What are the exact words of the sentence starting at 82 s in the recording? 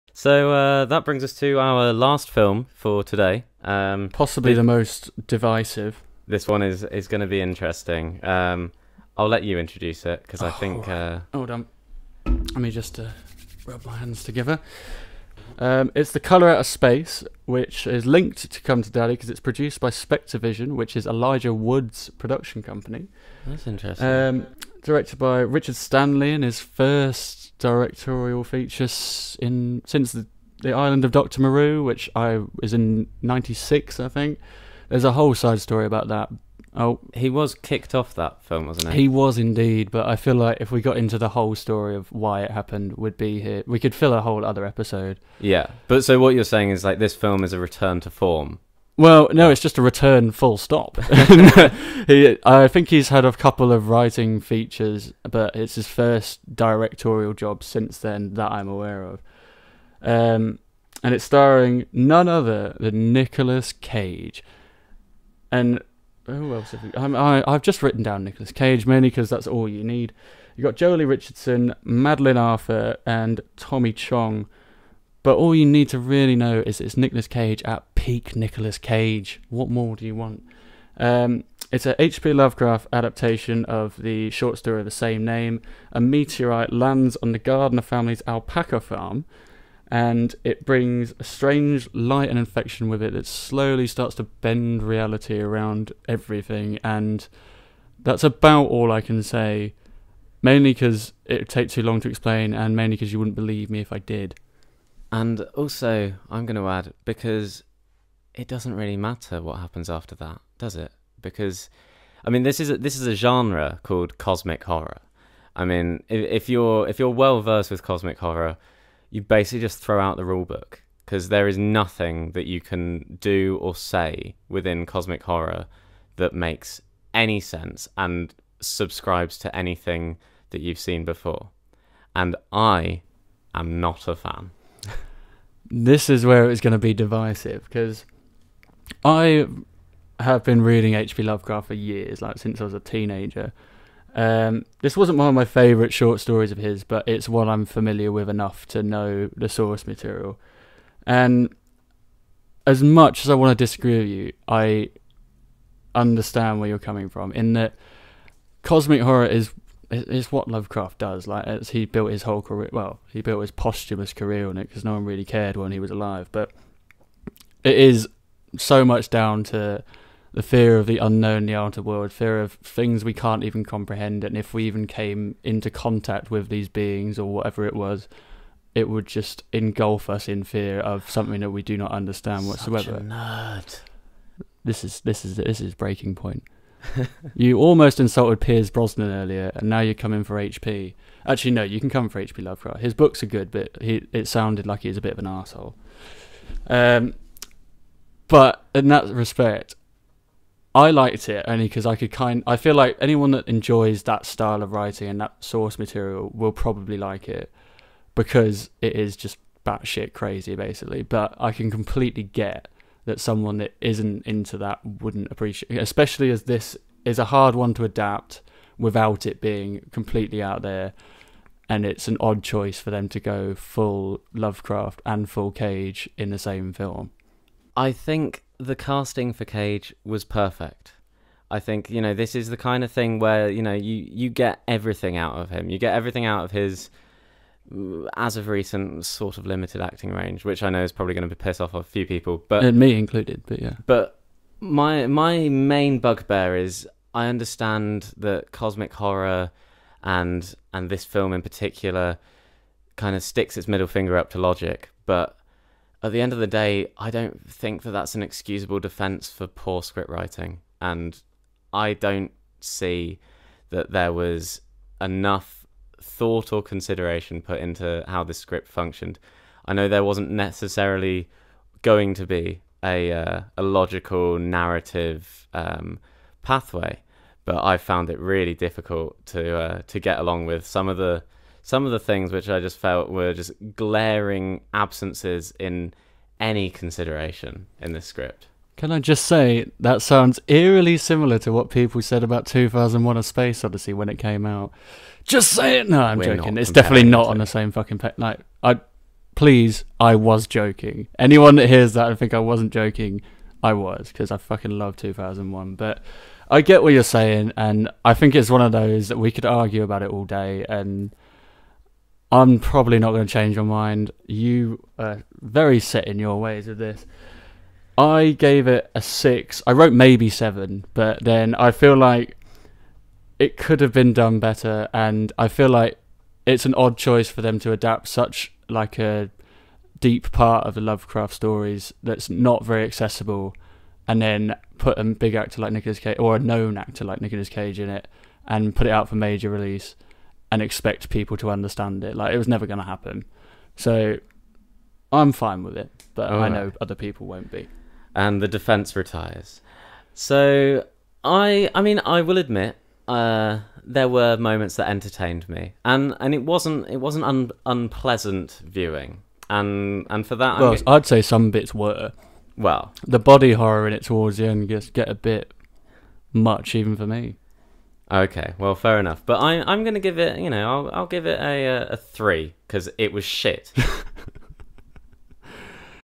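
Lovecraft adaptation of the short story of the same name.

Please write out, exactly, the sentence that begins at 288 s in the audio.
Can I just say that sounds eerily similar to what people said about 2001: A Space Odyssey when it came out?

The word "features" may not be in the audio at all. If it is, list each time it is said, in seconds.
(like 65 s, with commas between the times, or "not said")
28 s, 54 s.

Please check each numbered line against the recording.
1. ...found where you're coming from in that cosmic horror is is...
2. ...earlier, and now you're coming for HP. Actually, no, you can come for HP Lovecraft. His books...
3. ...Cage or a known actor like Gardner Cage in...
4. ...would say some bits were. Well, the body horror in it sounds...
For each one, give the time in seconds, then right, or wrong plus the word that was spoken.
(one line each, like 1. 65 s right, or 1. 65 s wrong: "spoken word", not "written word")
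1. 155 s wrong: "understand", not "found"
2. 189 s right
3. 335 s wrong: "Nicolas", not "Gardner"
4. 360 s wrong: "towards", not "sounds".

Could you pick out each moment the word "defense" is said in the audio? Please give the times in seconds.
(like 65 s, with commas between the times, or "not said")
258 s, 348 s.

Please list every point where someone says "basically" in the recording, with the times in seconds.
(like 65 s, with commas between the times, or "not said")
119 s, 210 s.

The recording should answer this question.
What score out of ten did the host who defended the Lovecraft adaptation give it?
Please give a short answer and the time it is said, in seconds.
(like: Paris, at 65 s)
6, at 319 s.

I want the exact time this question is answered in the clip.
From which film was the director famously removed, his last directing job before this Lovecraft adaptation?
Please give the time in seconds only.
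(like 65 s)
30 s.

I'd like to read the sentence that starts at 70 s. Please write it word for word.
You got Joely Richardson, Madeleine Arthur, and Tommy Chong.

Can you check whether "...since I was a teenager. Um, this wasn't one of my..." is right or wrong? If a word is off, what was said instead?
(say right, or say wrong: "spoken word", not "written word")
right.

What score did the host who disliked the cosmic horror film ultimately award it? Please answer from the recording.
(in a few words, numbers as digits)
3.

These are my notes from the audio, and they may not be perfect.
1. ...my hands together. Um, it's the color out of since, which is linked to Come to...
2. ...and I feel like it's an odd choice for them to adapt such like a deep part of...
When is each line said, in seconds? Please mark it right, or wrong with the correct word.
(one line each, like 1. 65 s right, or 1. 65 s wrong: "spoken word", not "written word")
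1. 13 s wrong: "space", not "since"
2. 324 s right.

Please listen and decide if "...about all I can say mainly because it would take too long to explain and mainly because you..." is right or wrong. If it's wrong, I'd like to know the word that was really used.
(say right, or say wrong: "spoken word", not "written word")
right.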